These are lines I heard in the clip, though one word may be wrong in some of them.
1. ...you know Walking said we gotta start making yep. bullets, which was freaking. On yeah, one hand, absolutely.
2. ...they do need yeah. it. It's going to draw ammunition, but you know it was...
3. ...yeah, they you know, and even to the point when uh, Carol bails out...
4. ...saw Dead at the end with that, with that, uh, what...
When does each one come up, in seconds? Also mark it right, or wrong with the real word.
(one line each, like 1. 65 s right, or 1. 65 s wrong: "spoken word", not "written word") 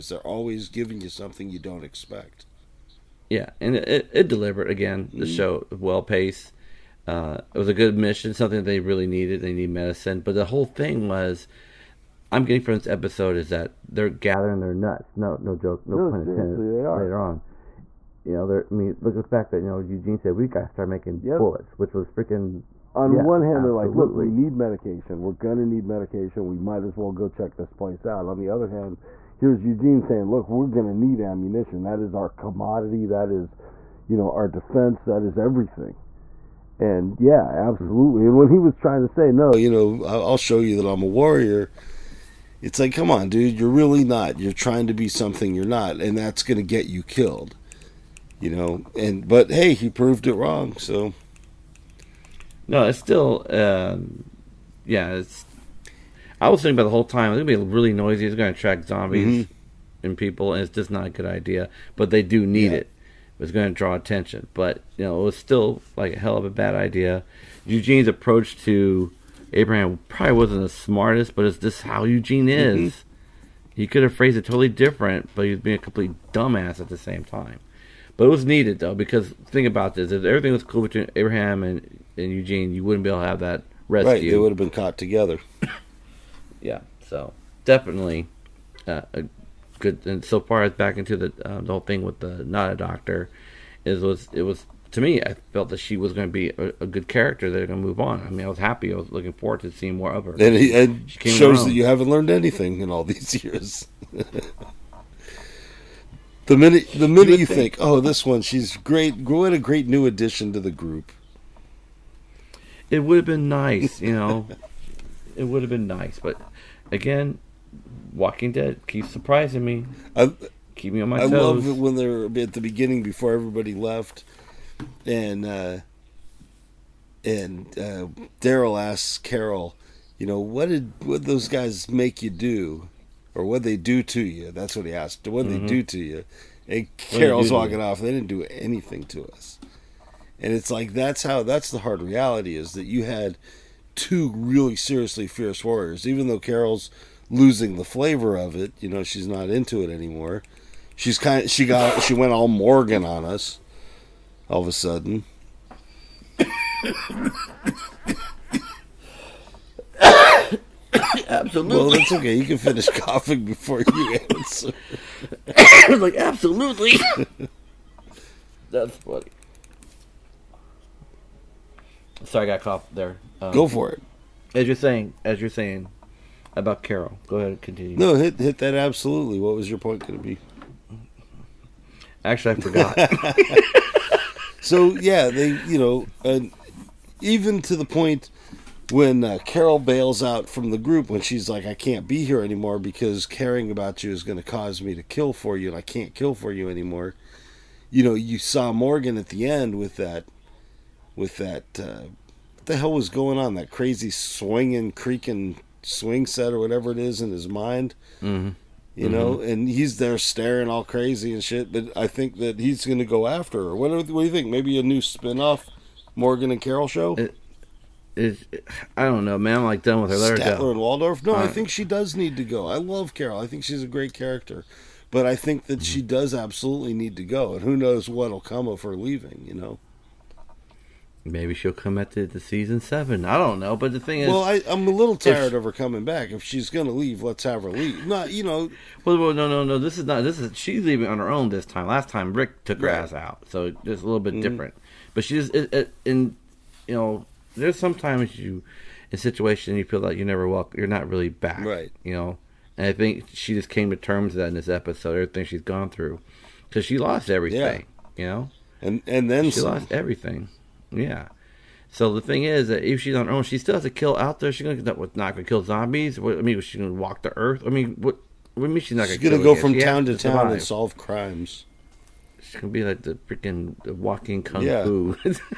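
1. 19 s wrong: "Eugene", not "Walking"
2. 62 s wrong: "attention", not "ammunition"
3. 184 s right
4. 198 s wrong: "Morgan", not "Dead".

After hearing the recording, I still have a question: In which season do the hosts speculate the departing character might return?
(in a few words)
Season 7.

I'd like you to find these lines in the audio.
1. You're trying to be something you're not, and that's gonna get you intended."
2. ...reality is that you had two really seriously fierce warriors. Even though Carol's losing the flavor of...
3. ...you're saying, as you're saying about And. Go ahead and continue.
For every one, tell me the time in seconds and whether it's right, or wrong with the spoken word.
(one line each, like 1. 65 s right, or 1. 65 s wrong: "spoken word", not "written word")
1. 44 s wrong: "killed", not "intended"
2. 142 s right
3. 174 s wrong: "Carol", not "And".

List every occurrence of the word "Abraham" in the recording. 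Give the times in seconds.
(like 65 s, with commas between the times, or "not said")
69 s, 81 s.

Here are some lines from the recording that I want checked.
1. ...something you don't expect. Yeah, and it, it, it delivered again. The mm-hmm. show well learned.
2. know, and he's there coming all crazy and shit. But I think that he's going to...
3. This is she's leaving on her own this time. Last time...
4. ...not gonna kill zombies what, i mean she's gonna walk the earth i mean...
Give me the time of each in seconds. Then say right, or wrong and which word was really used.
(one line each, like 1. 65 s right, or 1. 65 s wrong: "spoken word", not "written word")
1. 1 s wrong: "paced", not "learned"
2. 209 s wrong: "staring", not "coming"
3. 240 s right
4. 265 s right.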